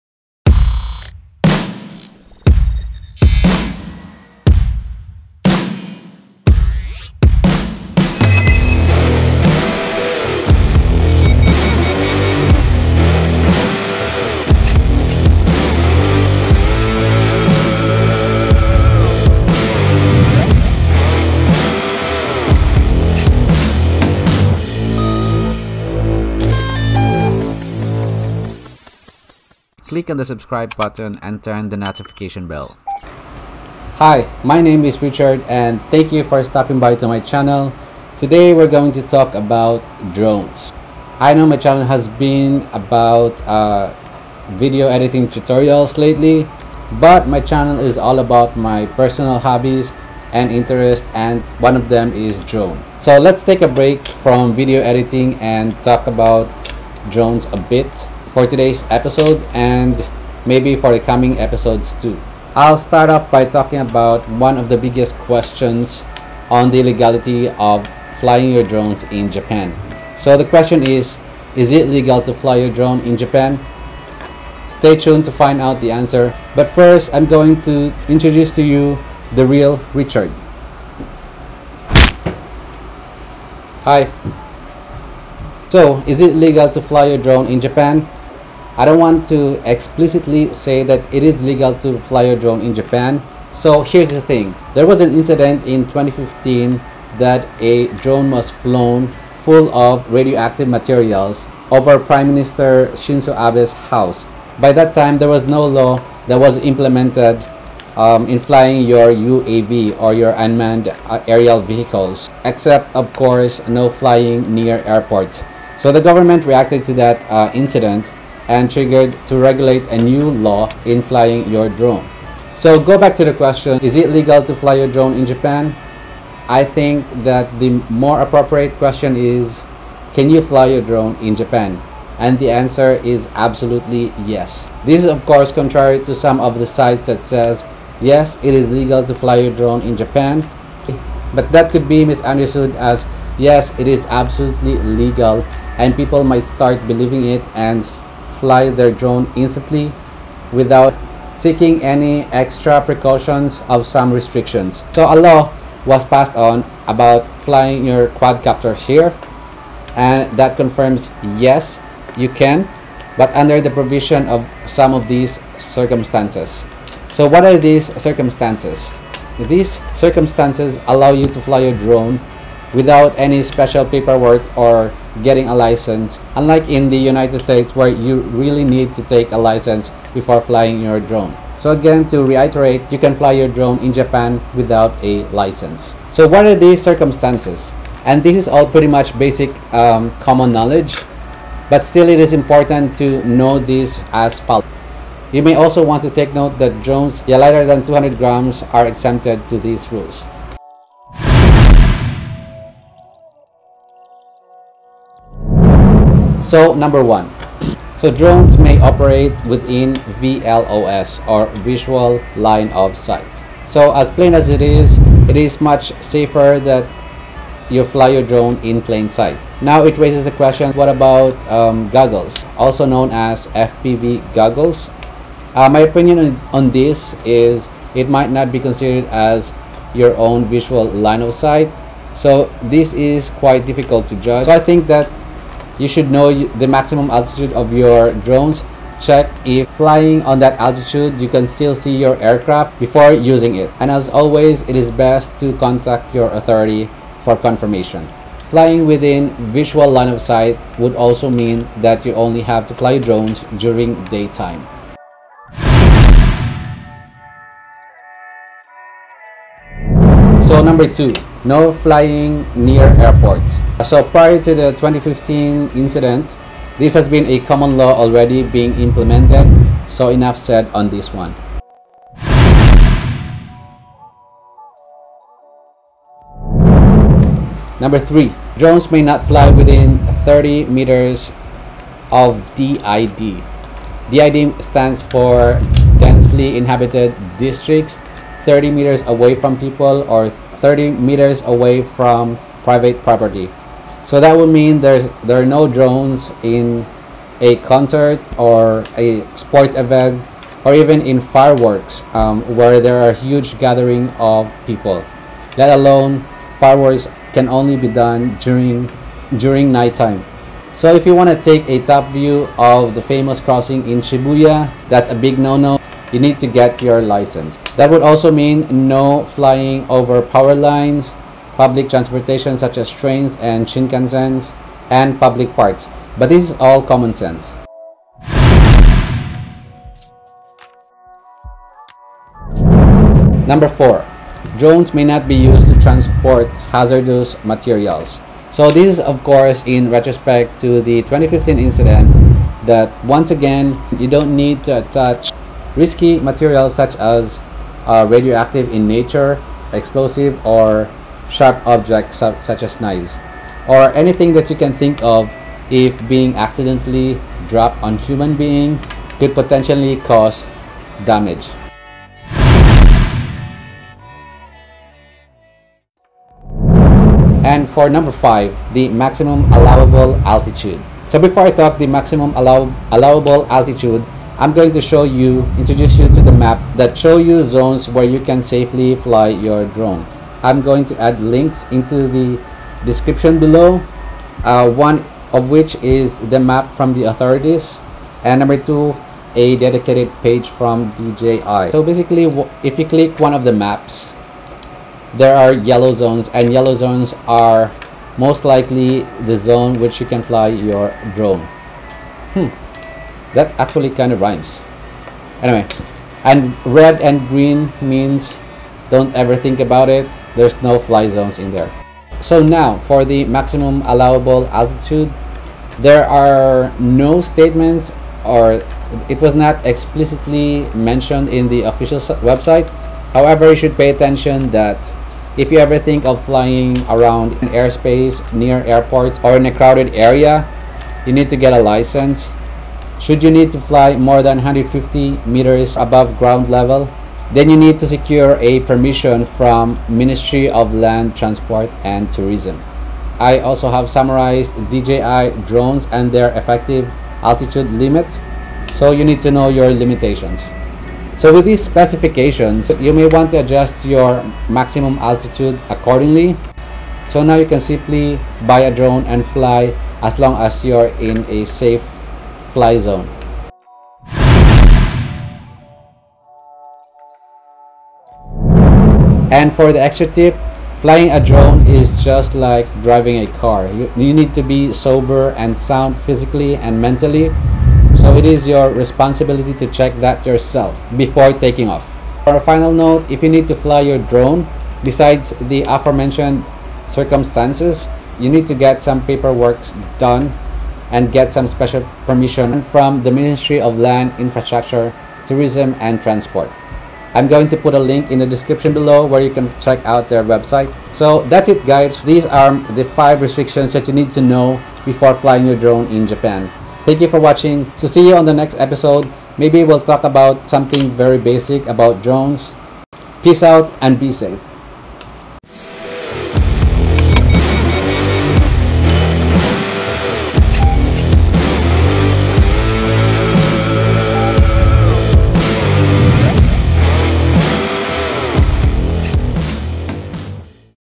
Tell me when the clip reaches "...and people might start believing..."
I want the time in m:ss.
2:25.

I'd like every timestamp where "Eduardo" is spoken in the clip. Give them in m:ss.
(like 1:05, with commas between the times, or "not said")
not said.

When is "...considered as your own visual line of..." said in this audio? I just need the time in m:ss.
3:48.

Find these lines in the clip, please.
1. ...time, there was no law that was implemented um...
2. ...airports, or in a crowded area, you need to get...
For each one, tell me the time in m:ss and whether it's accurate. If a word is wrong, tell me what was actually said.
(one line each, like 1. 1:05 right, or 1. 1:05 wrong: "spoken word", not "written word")
1. 1:44 right
2. 7:08 right.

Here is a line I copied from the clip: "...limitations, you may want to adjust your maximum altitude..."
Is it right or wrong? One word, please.
wrong.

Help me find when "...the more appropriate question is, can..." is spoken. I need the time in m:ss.
2:07.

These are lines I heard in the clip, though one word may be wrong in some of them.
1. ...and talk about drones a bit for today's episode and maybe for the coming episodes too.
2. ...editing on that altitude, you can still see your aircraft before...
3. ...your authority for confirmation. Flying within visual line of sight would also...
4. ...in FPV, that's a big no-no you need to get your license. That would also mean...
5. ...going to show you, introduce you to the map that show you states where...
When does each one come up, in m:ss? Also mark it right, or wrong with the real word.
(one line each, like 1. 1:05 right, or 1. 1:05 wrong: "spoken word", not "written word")
1. 0:55 right
2. 3:59 wrong: "flying", not "editing"
3. 4:06 right
4. 5:13 wrong: "Shibuya", not "FPV"
5. 6:14 wrong: "zones", not "states".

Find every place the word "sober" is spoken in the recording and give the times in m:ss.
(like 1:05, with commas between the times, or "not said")
7:54.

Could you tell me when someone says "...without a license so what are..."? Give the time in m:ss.
3:04.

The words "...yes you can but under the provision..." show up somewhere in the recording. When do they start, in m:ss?
2:41.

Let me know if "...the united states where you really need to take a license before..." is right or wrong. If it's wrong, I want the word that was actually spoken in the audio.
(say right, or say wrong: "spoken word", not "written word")
right.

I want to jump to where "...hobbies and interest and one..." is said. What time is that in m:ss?
0:49.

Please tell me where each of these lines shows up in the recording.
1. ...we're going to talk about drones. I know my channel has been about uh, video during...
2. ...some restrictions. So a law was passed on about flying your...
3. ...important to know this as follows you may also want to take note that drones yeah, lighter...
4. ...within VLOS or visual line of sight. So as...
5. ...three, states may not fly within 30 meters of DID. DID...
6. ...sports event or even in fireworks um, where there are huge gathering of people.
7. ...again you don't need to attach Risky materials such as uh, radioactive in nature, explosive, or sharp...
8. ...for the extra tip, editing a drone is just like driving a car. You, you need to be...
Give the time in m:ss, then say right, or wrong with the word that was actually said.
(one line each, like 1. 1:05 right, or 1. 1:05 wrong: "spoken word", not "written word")
1. 0:38 wrong: "editing", not "during"
2. 2:33 right
3. 3:12 right
4. 3:29 right
5. 4:37 wrong: "drones", not "states"
6. 4:59 right
7. 5:43 right
8. 7:49 wrong: "flying", not "editing".